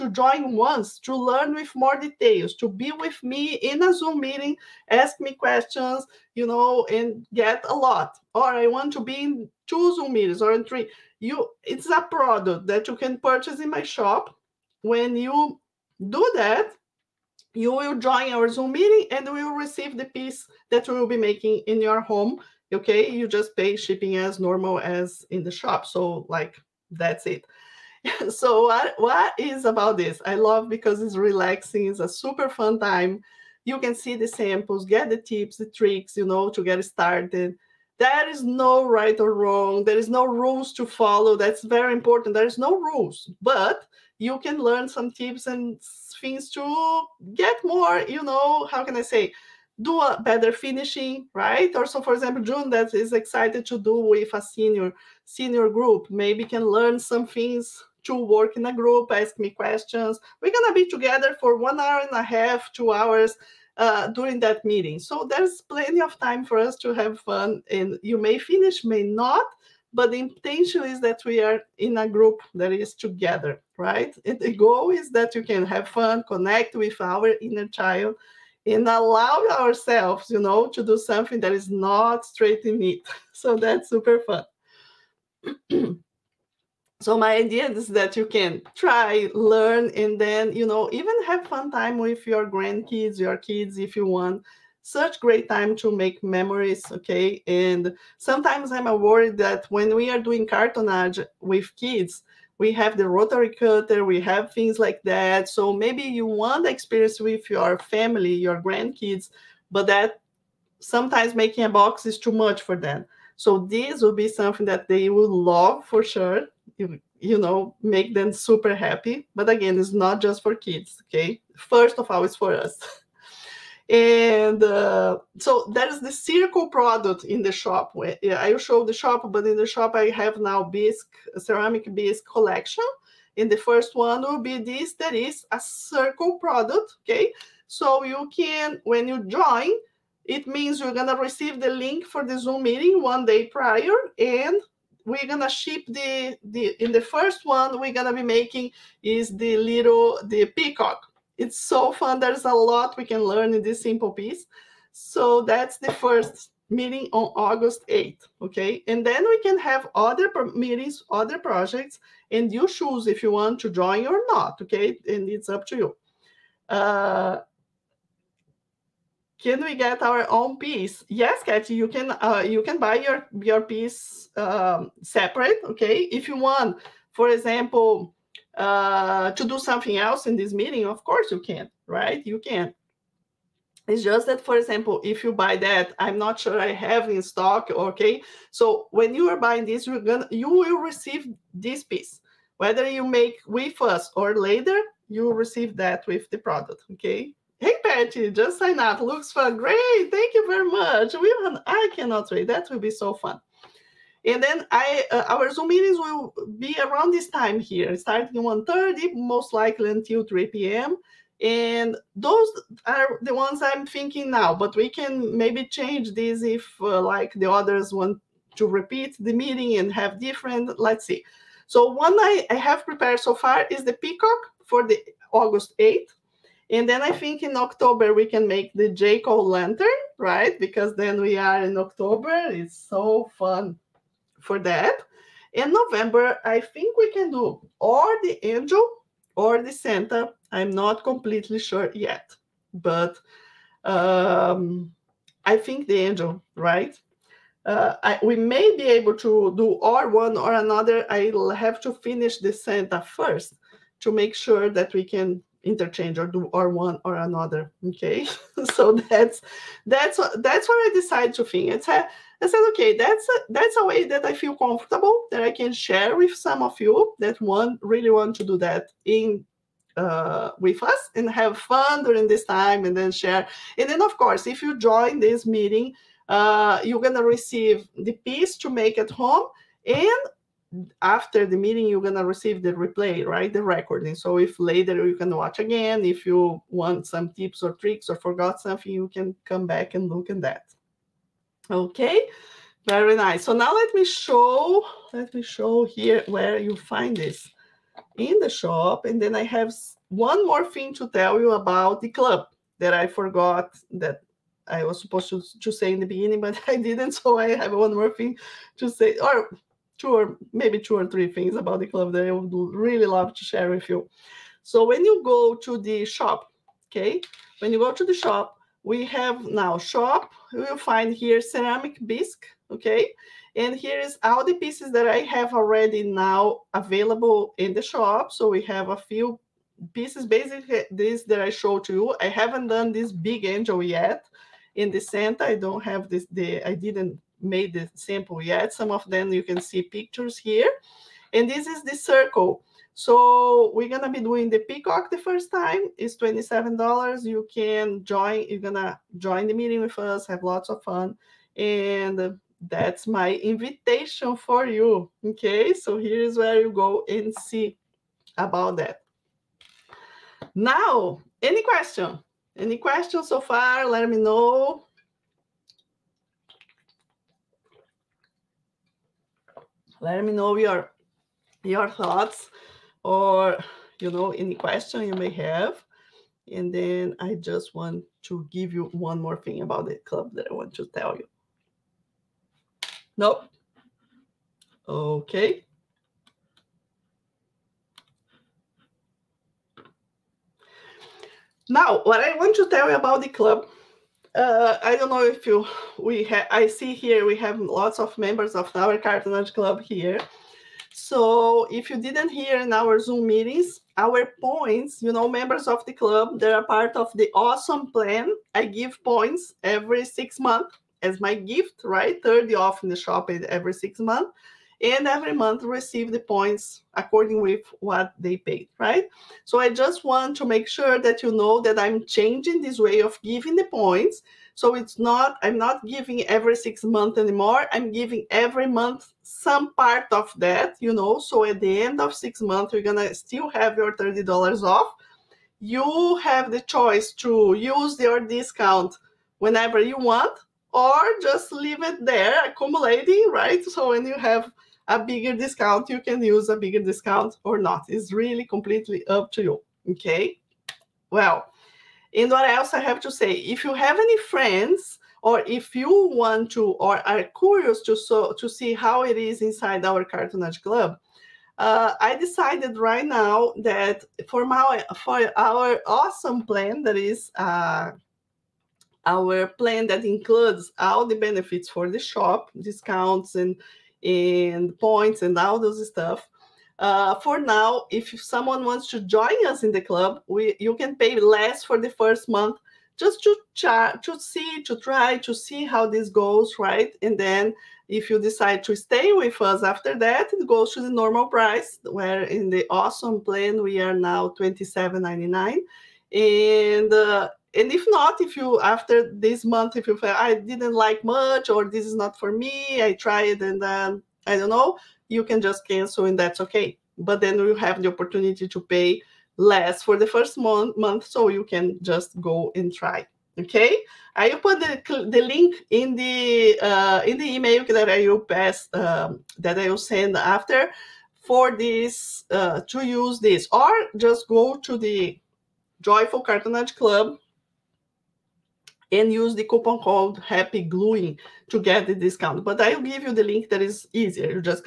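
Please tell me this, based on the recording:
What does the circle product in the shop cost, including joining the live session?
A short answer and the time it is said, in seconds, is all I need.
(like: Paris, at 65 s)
$27, at 346 s.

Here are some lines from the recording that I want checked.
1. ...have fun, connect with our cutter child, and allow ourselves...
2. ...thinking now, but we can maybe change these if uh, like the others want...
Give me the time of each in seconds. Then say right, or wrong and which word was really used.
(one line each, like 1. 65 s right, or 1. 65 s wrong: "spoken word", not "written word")
1. 75 s wrong: "inner", not "cutter"
2. 213 s right.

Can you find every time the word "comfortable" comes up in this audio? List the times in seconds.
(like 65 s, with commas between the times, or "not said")
264 s.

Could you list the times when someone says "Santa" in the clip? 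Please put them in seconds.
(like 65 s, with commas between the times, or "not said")
239 s, 252 s.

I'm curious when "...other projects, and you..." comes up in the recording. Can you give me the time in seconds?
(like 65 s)
161 s.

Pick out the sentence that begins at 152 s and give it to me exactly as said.
There's a lot we can learn in this simple piece.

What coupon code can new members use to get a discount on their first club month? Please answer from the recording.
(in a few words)
happy gluing.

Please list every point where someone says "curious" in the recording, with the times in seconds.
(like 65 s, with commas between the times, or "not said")
457 s.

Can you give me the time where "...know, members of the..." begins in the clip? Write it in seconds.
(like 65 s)
405 s.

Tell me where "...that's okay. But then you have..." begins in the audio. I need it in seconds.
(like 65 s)
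506 s.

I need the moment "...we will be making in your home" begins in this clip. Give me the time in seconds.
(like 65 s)
20 s.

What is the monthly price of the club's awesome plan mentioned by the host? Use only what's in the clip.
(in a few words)
$27.99.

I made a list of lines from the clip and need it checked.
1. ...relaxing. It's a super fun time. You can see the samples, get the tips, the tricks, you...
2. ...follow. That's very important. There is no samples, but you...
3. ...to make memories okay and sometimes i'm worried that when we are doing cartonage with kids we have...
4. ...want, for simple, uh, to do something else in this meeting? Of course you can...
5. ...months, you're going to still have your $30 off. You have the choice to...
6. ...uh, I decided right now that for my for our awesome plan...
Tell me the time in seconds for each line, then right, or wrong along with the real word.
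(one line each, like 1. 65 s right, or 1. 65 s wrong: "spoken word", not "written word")
1. 31 s right
2. 40 s wrong: "rules", not "samples"
3. 95 s right
4. 176 s wrong: "example", not "simple"
5. 432 s right
6. 461 s right.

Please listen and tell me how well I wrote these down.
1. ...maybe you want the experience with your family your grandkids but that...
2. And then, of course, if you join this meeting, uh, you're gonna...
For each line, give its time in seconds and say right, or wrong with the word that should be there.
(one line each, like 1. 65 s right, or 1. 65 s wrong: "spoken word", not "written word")
1. 105 s right
2. 273 s right.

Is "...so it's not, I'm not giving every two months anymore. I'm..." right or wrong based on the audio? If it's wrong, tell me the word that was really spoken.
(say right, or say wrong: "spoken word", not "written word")
wrong: "six", not "two".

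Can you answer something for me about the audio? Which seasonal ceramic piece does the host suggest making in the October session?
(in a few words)
Jack o' lantern.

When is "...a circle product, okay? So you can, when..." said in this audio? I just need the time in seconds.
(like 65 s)
135 s.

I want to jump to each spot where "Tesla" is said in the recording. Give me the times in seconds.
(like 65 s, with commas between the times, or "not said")
not said.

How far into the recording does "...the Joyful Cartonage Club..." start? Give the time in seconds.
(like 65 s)
524 s.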